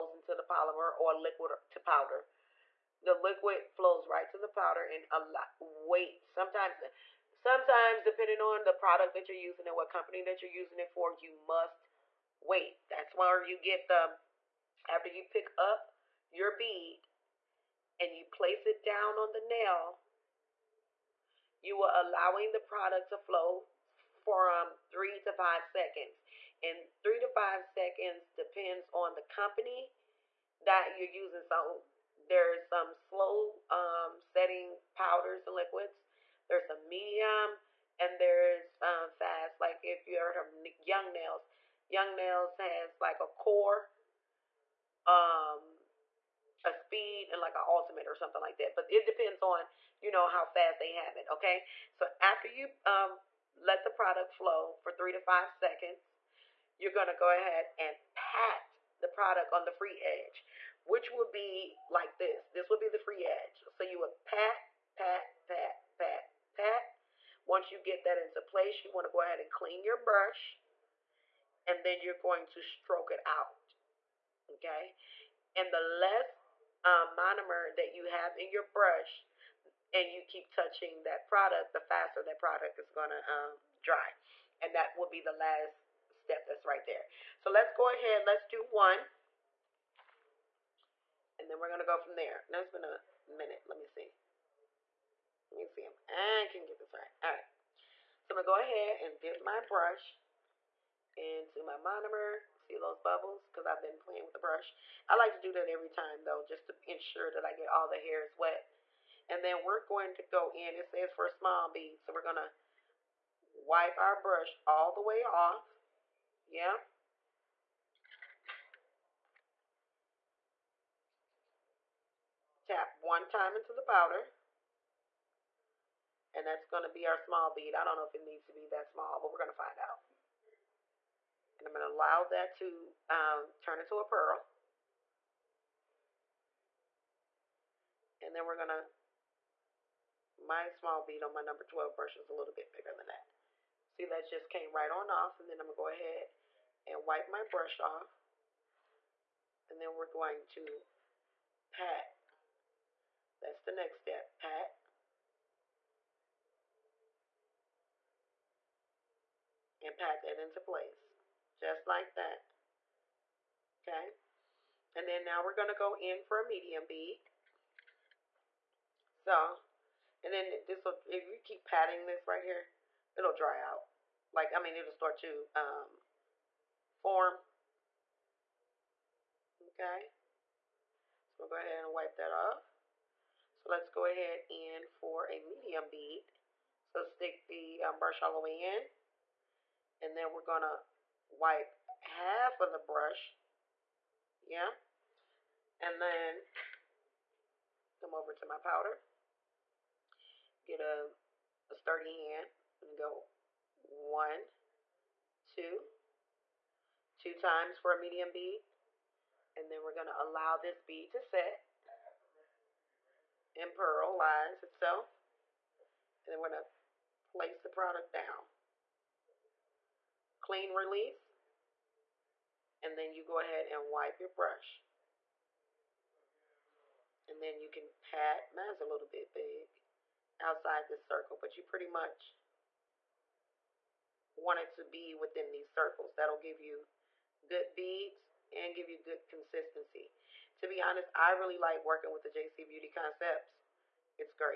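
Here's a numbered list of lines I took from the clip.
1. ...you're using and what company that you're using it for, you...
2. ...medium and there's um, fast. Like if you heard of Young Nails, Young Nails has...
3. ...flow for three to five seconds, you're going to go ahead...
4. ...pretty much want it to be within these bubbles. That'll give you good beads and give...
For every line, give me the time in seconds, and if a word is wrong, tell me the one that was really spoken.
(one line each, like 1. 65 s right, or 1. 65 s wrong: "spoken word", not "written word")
1. 9 s right
2. 36 s right
3. 54 s right
4. 231 s wrong: "circles", not "bubbles".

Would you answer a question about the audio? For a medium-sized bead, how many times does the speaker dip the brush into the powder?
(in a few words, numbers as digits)
2.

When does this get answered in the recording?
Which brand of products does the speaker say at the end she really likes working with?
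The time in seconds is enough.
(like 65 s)
242 s.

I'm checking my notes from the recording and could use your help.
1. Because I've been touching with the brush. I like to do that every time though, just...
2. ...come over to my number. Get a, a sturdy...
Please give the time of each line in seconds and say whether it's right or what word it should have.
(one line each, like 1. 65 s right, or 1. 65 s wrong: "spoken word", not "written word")
1. 103 s wrong: "playing", not "touching"
2. 198 s wrong: "powder", not "number".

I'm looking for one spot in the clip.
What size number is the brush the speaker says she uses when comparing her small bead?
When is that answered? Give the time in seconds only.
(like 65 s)
141 s.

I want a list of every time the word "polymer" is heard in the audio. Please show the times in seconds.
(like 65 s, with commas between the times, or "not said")
0 s.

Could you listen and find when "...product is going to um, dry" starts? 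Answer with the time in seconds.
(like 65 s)
82 s.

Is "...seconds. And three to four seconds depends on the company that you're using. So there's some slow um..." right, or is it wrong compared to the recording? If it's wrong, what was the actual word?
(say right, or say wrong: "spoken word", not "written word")
wrong: "five", not "four".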